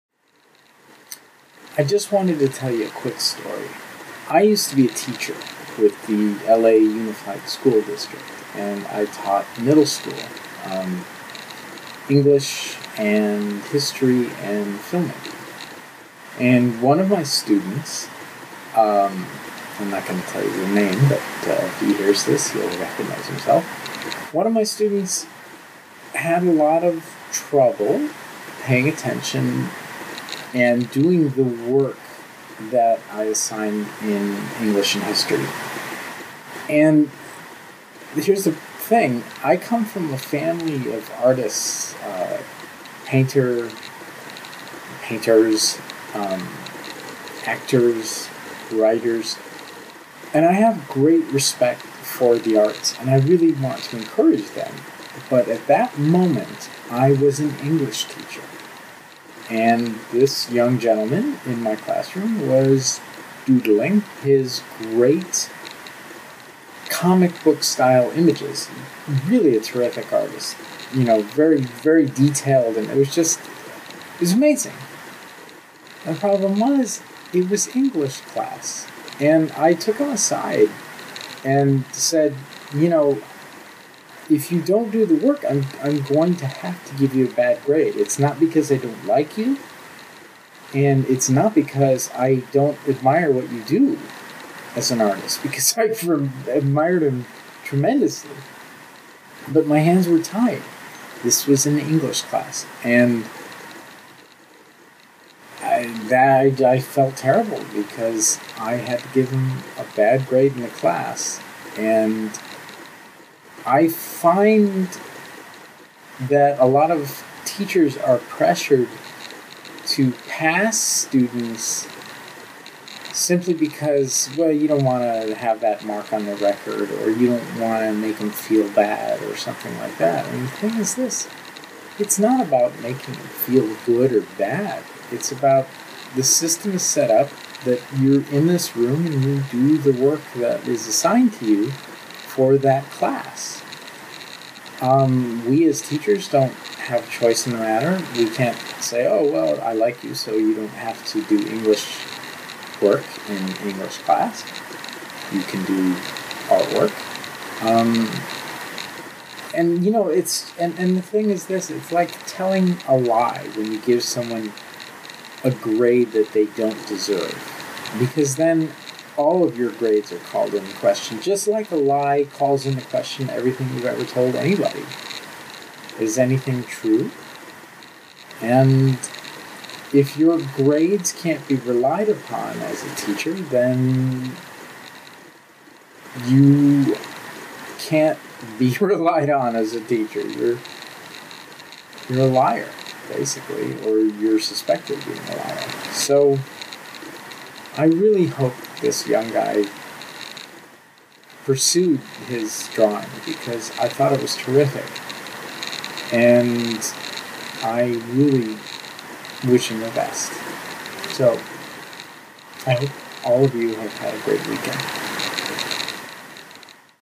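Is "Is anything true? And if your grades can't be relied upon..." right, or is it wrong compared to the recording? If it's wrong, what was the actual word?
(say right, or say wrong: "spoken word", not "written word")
right.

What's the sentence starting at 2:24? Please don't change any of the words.
Um, we as teachers don't have choice in the matter.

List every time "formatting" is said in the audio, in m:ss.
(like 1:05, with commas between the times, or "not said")
not said.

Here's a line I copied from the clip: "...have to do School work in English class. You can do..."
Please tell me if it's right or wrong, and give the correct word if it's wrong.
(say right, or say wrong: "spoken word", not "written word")
wrong: "English", not "School".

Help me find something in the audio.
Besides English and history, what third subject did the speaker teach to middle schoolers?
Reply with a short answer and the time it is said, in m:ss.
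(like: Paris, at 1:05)
Filmmaking, at 0:14.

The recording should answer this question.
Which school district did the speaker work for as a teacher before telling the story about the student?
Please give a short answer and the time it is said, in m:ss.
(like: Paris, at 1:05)
LA Unified School District, at 0:06.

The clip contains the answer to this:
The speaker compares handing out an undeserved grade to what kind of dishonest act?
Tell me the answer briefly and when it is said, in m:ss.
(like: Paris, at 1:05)
Telling a lie, at 2:42.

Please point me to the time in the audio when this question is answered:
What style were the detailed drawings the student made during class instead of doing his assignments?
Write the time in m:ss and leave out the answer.
1:06.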